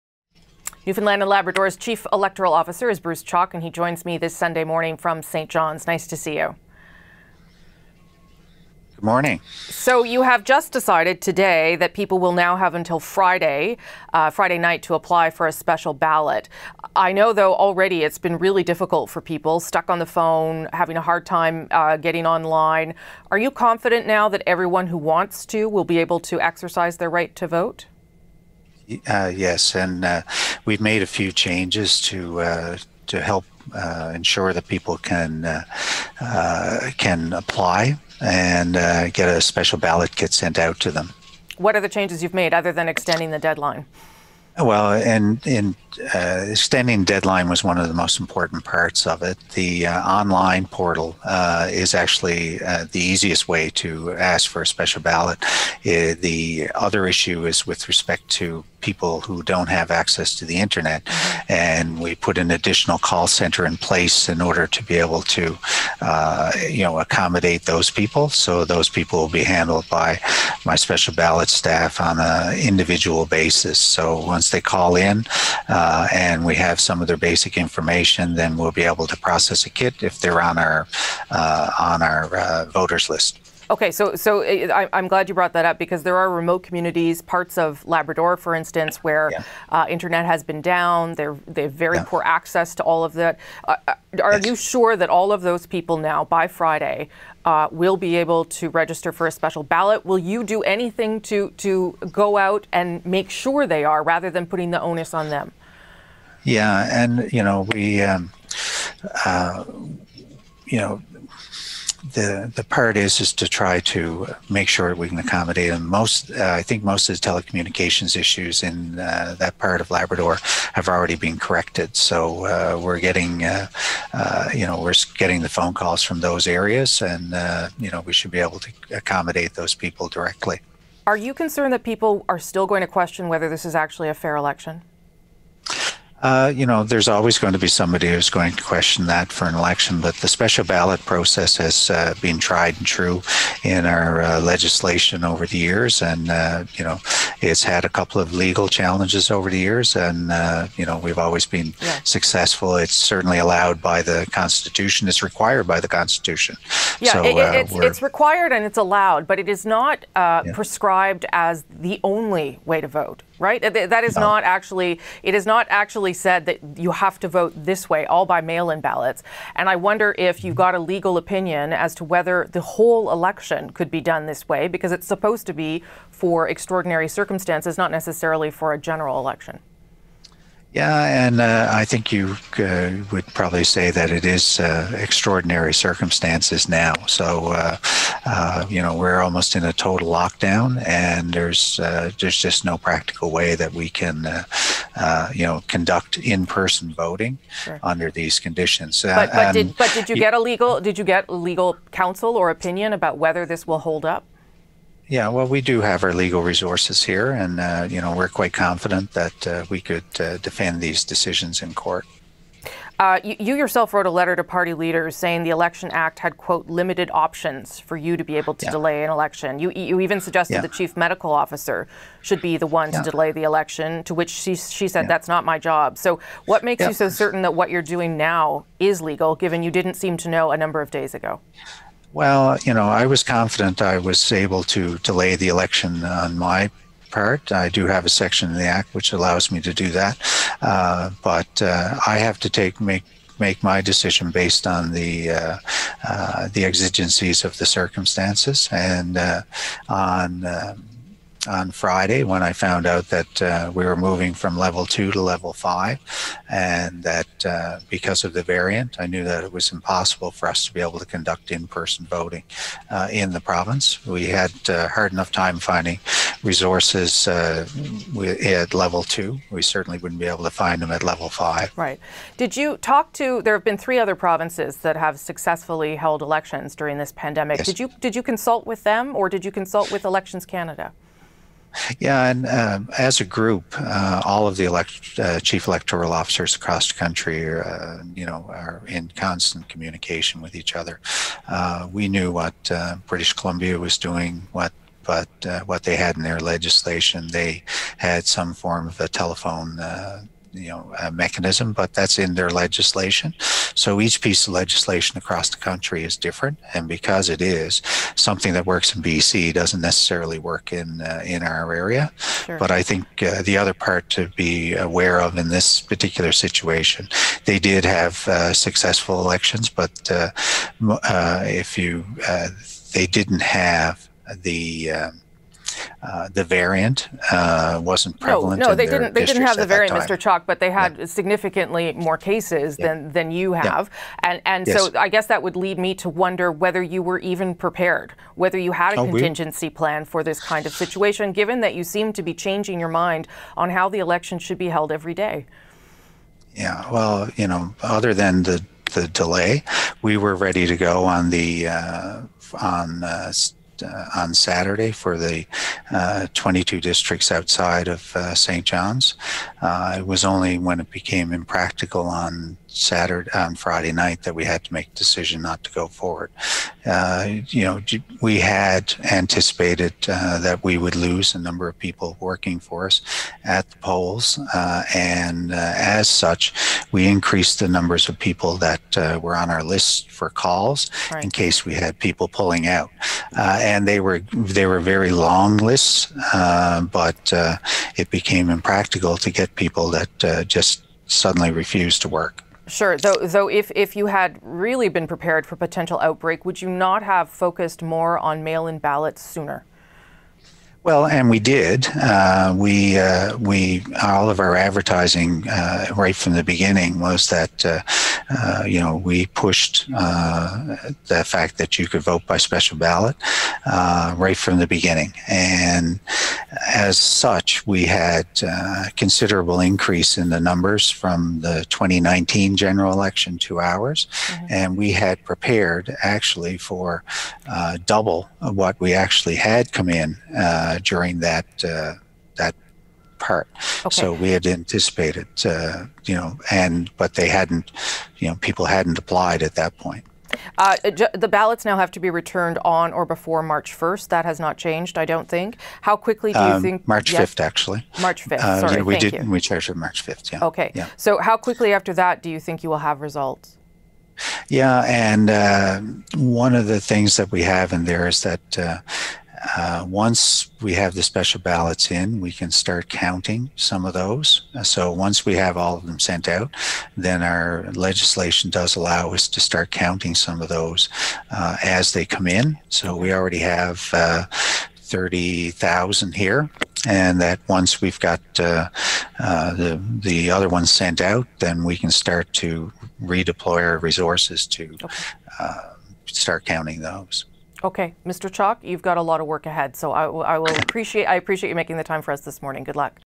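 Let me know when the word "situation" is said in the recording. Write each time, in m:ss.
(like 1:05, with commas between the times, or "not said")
5:16, 5:40.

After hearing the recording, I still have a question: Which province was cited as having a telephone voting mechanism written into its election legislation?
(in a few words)
British Columbia.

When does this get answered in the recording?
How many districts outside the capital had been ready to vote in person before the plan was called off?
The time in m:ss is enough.
5:56.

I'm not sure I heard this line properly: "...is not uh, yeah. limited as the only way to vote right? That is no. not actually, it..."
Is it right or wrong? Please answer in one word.
wrong.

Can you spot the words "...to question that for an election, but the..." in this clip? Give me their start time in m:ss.
2:18.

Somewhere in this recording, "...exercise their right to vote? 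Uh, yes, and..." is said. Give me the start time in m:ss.
0:26.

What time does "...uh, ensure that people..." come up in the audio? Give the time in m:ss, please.
0:33.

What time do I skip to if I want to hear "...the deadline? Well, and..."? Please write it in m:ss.
0:43.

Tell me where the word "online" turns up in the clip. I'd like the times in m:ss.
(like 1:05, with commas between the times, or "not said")
0:22, 0:50.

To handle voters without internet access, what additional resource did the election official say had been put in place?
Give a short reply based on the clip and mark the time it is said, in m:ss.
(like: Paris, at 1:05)
call center, at 1:02.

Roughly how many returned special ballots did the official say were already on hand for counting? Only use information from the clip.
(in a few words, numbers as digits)
30,000.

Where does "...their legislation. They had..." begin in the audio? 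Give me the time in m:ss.
4:56.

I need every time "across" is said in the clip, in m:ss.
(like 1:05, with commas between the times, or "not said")
4:46, 5:05.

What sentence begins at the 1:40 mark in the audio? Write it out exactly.
Will you do anything to to go out and make sure they are, rather than putting the onus on them?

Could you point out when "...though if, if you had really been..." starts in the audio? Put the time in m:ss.
6:33.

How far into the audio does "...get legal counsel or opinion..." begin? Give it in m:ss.
3:21.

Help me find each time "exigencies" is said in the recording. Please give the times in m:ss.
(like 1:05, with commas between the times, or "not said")
4:06.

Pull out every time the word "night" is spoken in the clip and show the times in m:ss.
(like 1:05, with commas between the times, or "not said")
0:14, 6:03.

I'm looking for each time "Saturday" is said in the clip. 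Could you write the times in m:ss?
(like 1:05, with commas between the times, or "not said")
5:54, 6:02.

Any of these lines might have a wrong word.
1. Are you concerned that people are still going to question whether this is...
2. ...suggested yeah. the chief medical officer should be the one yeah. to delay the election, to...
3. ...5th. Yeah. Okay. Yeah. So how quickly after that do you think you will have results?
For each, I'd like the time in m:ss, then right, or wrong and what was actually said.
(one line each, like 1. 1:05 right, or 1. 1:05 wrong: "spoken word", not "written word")
1. 2:11 right
2. 3:40 right
3. 7:30 right.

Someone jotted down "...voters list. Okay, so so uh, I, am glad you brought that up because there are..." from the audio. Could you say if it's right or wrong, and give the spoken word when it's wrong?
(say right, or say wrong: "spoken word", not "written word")
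right.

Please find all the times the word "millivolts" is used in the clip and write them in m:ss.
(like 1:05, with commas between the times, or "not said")
not said.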